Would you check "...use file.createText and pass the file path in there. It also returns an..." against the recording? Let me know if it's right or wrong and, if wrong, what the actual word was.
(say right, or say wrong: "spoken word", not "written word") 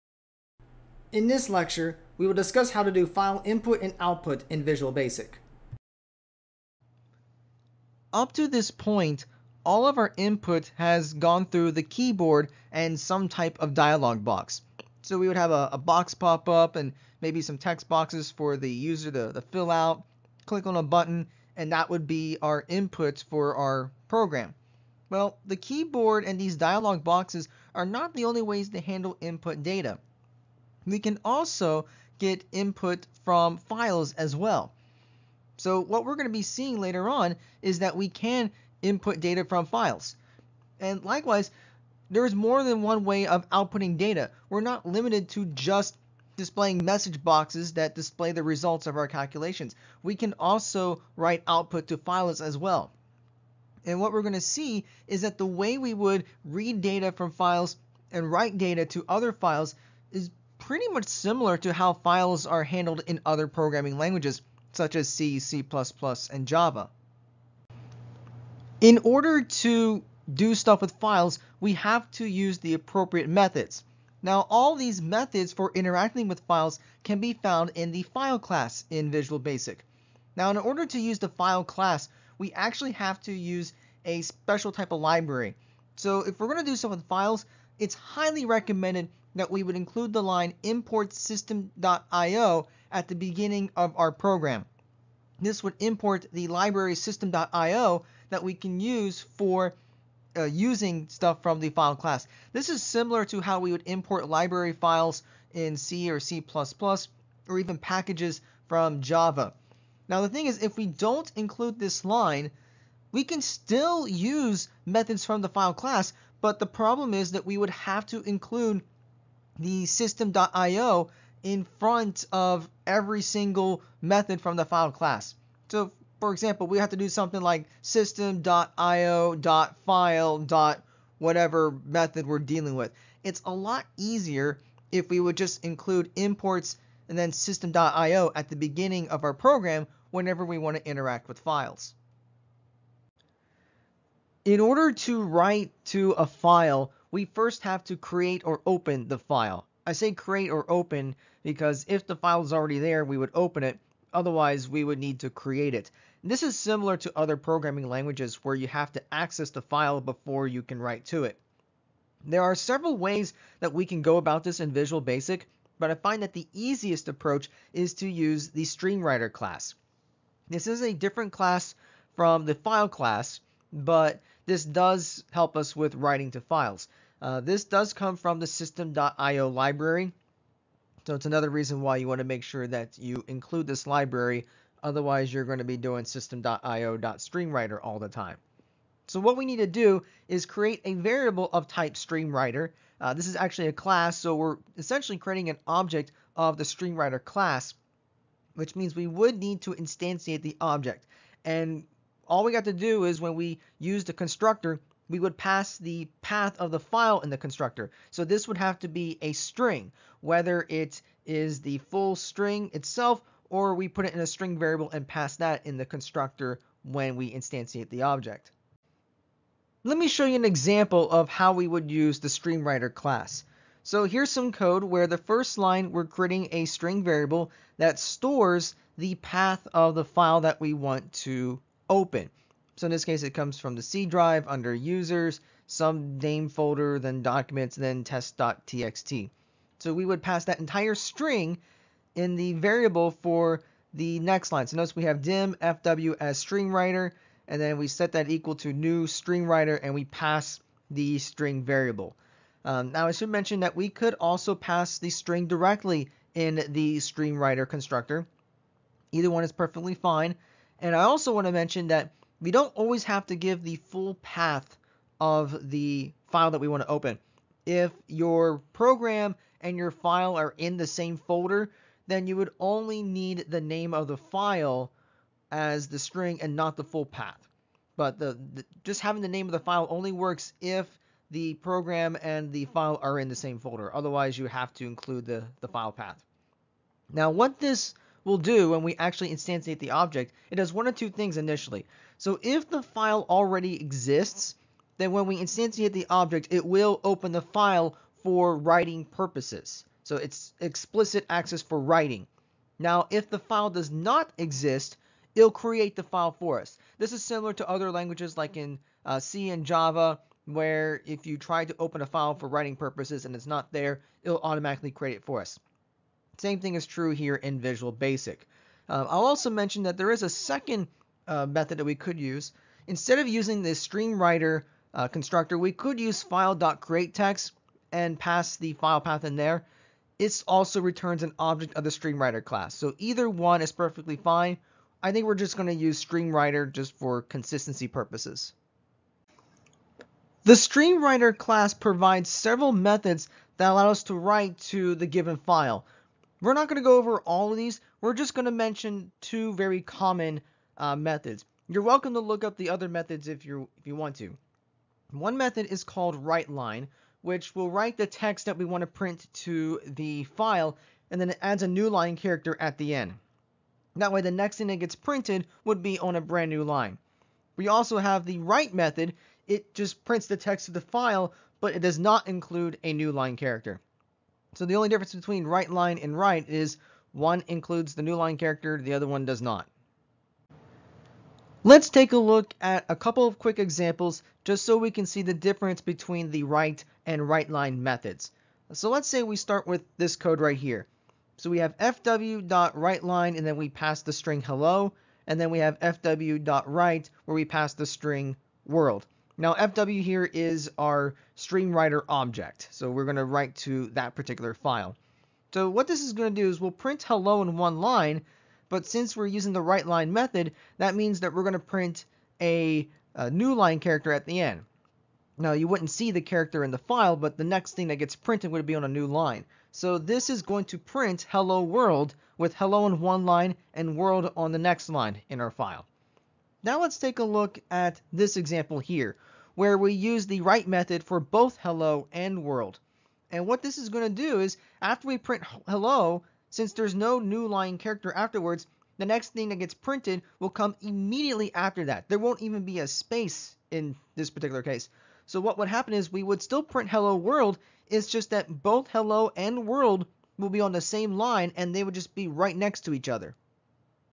right.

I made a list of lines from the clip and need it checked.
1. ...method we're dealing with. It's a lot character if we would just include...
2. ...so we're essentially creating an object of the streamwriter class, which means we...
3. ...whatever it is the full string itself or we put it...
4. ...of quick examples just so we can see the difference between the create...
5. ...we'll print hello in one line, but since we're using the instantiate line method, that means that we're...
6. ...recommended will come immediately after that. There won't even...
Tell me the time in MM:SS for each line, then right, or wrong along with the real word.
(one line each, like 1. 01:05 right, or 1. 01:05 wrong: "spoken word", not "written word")
1. 02:11 wrong: "easier", not "character"
2. 03:14 right
3. 03:30 wrong: "whether", not "whatever"
4. 06:23 wrong: "write", not "create"
5. 06:46 wrong: "write", not "instantiate"
6. 07:19 wrong: "printed", not "recommended".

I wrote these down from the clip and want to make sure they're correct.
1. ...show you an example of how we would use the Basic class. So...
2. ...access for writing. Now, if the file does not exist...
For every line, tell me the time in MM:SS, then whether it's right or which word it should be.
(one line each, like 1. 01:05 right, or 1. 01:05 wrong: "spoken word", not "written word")
1. 03:40 wrong: "StreamWriter", not "Basic"
2. 05:01 right.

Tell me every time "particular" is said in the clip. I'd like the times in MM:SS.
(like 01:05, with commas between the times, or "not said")
06:44, 07:24.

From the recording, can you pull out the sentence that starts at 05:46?
We're not going to go over all of these.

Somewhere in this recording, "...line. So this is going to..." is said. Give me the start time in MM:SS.
06:59.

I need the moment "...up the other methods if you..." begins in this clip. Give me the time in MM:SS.
05:52.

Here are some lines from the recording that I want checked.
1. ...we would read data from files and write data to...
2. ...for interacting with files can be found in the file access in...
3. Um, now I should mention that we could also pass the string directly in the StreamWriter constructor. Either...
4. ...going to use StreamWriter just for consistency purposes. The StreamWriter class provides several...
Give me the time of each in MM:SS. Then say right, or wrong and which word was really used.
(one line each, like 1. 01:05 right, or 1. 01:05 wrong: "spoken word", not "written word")
1. 00:55 right
2. 01:15 wrong: "class", not "access"
3. 04:12 right
4. 05:35 right.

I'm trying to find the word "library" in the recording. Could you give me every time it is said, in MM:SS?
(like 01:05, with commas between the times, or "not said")
01:25, 01:36, 01:44, 02:59, 03:03.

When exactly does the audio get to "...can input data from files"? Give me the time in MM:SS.
00:38.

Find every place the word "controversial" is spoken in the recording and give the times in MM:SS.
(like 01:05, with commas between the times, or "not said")
not said.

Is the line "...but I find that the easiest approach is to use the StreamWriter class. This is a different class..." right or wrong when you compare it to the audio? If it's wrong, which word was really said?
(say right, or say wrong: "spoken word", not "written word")
right.